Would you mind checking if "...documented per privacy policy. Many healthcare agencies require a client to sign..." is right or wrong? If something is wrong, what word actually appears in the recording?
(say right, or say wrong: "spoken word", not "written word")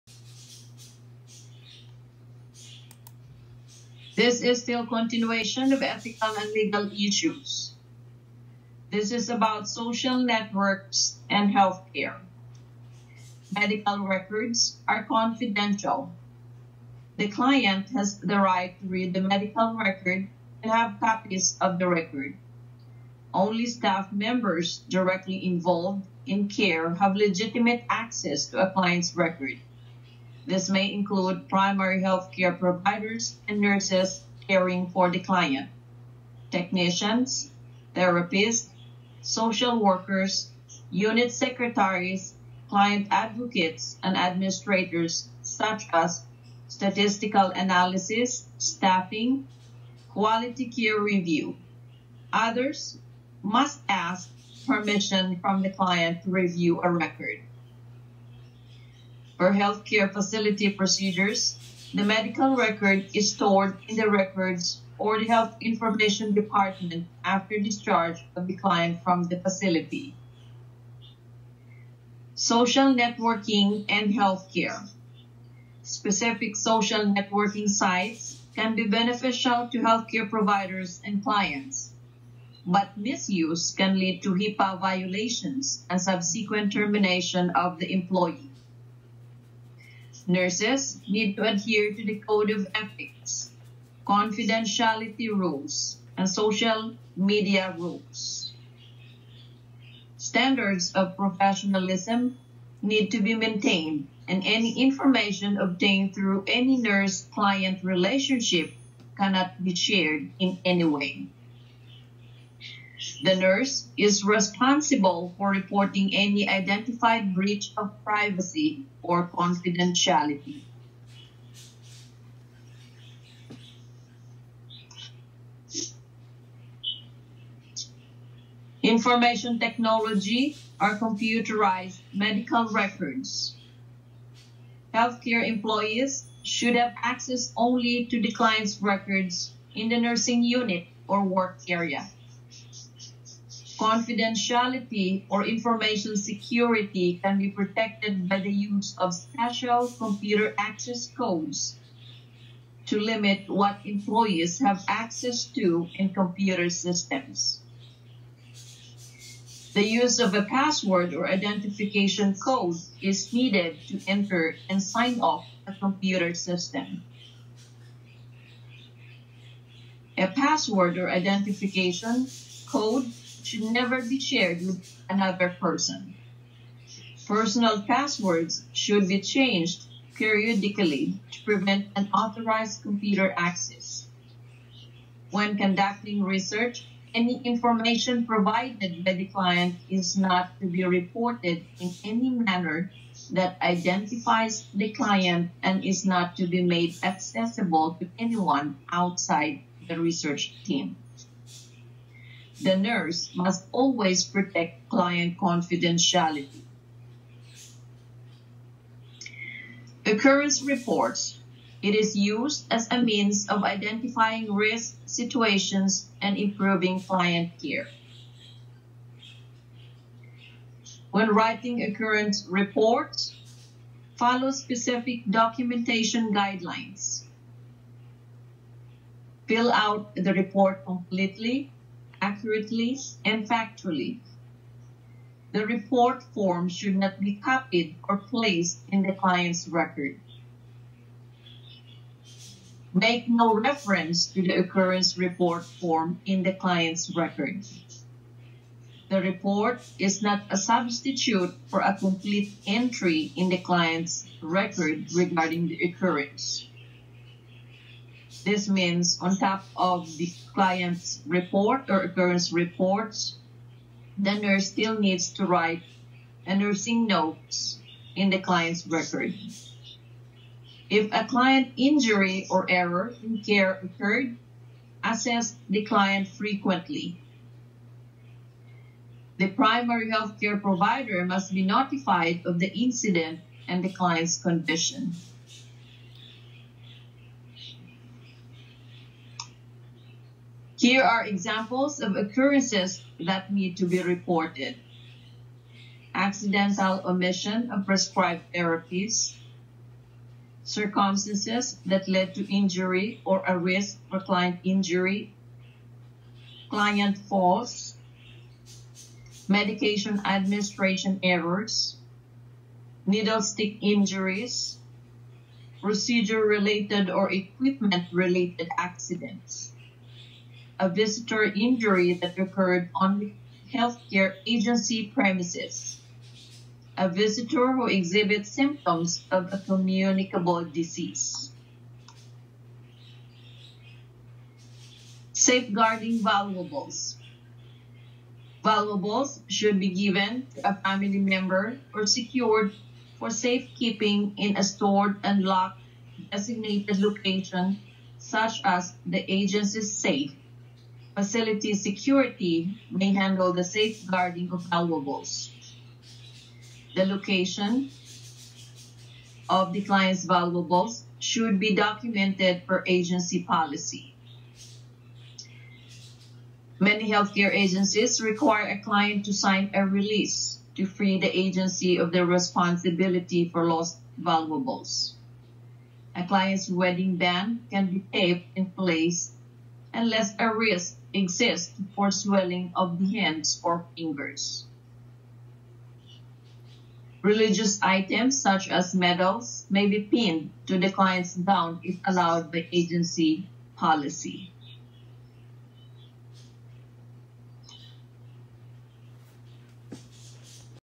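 wrong: "agency", not "privacy".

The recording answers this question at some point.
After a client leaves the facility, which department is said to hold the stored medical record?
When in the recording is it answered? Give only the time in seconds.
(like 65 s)
65 s.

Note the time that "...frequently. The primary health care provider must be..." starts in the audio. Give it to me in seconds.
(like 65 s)
276 s.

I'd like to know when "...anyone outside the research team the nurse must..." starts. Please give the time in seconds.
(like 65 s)
198 s.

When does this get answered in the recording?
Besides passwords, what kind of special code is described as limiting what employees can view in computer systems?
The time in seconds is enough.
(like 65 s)
149 s.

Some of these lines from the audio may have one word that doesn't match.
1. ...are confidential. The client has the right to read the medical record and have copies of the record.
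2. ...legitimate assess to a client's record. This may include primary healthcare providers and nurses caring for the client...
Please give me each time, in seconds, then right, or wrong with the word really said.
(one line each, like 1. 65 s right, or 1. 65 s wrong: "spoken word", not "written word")
1. 14 s right
2. 27 s wrong: "access", not "assess".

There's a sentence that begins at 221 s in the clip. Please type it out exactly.
When writing occurrence reports, follow specific documentation guidelines.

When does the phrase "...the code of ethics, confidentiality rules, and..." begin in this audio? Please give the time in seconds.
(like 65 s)
92 s.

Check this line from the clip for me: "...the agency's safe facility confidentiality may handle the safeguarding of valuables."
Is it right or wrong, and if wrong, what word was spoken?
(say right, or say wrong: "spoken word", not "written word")
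wrong: "security", not "confidentiality".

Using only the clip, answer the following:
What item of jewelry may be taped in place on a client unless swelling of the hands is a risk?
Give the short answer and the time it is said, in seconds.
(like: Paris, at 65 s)
Wedding band, at 376 s.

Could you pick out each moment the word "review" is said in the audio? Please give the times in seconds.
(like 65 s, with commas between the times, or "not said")
50 s, 56 s.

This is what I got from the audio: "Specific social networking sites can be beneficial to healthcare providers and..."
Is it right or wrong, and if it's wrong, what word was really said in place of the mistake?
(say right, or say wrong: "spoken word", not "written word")
right.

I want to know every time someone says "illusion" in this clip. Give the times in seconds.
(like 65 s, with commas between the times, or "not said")
not said.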